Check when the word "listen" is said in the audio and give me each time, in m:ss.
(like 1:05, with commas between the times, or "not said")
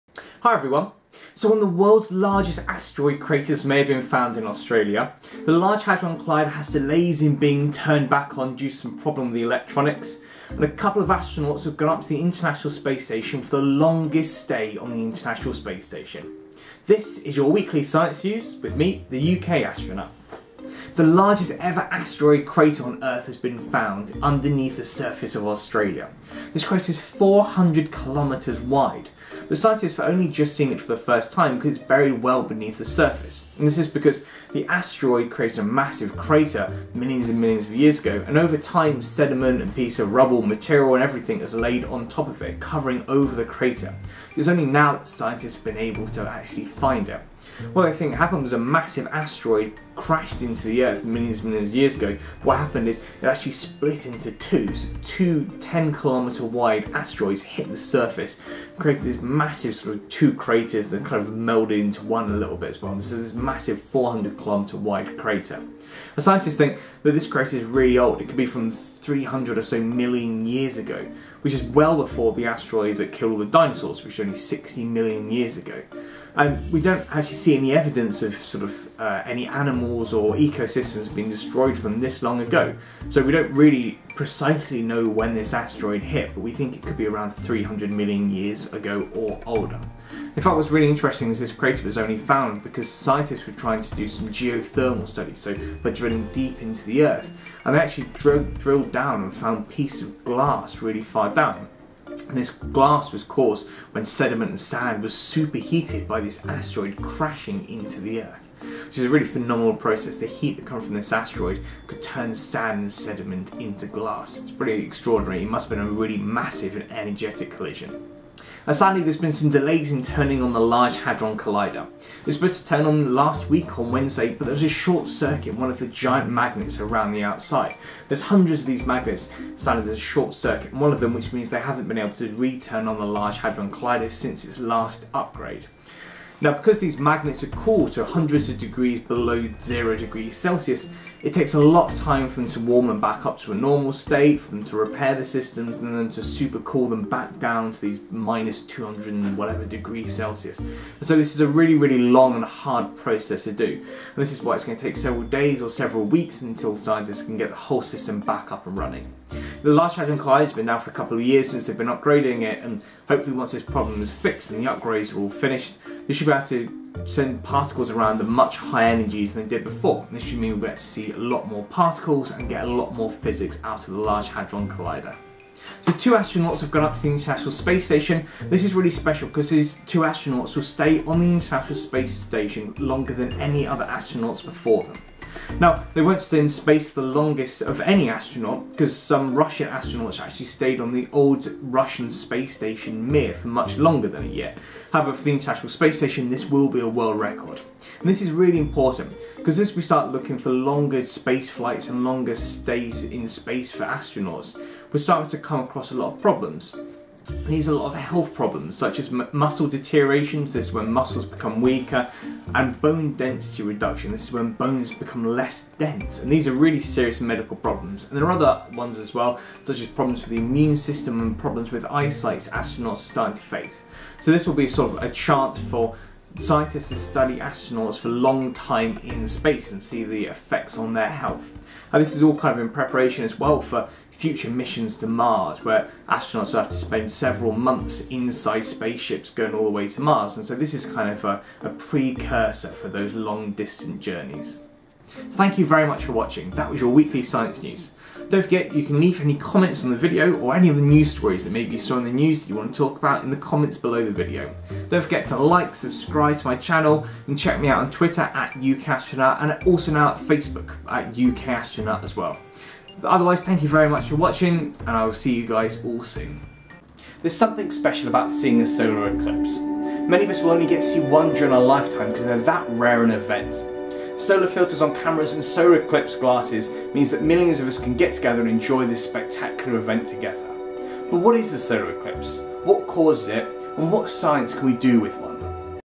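not said.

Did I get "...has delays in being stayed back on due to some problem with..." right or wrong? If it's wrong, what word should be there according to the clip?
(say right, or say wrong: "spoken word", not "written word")
wrong: "turned", not "stayed".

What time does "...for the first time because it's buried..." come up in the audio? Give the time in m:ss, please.
0:30.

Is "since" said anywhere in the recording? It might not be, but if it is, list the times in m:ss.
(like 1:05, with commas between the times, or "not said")
2:14, 2:41.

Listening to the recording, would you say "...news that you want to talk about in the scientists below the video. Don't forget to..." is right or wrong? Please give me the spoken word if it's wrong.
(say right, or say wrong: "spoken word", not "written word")
wrong: "comments", not "scientists".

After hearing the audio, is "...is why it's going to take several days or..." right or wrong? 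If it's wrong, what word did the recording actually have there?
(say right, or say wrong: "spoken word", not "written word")
right.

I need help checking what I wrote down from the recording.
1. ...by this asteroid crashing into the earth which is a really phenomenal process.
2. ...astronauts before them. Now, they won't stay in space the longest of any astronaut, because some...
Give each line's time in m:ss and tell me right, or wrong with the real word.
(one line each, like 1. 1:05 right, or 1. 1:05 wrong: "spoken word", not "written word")
1. 1:46 right
2. 3:03 right.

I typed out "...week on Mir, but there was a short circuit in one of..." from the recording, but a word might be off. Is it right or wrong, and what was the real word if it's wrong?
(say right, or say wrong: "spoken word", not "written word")
wrong: "Wednesday", not "Mir".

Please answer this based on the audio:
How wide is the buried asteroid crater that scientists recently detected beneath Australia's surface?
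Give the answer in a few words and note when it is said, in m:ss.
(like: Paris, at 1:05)
400 kilometres, at 0:26.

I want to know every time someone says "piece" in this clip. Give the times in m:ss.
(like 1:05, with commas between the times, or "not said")
0:39, 1:39.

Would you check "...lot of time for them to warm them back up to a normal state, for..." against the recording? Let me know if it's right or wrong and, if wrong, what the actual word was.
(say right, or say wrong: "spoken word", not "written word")
right.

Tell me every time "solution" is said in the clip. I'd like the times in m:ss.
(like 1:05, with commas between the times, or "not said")
not said.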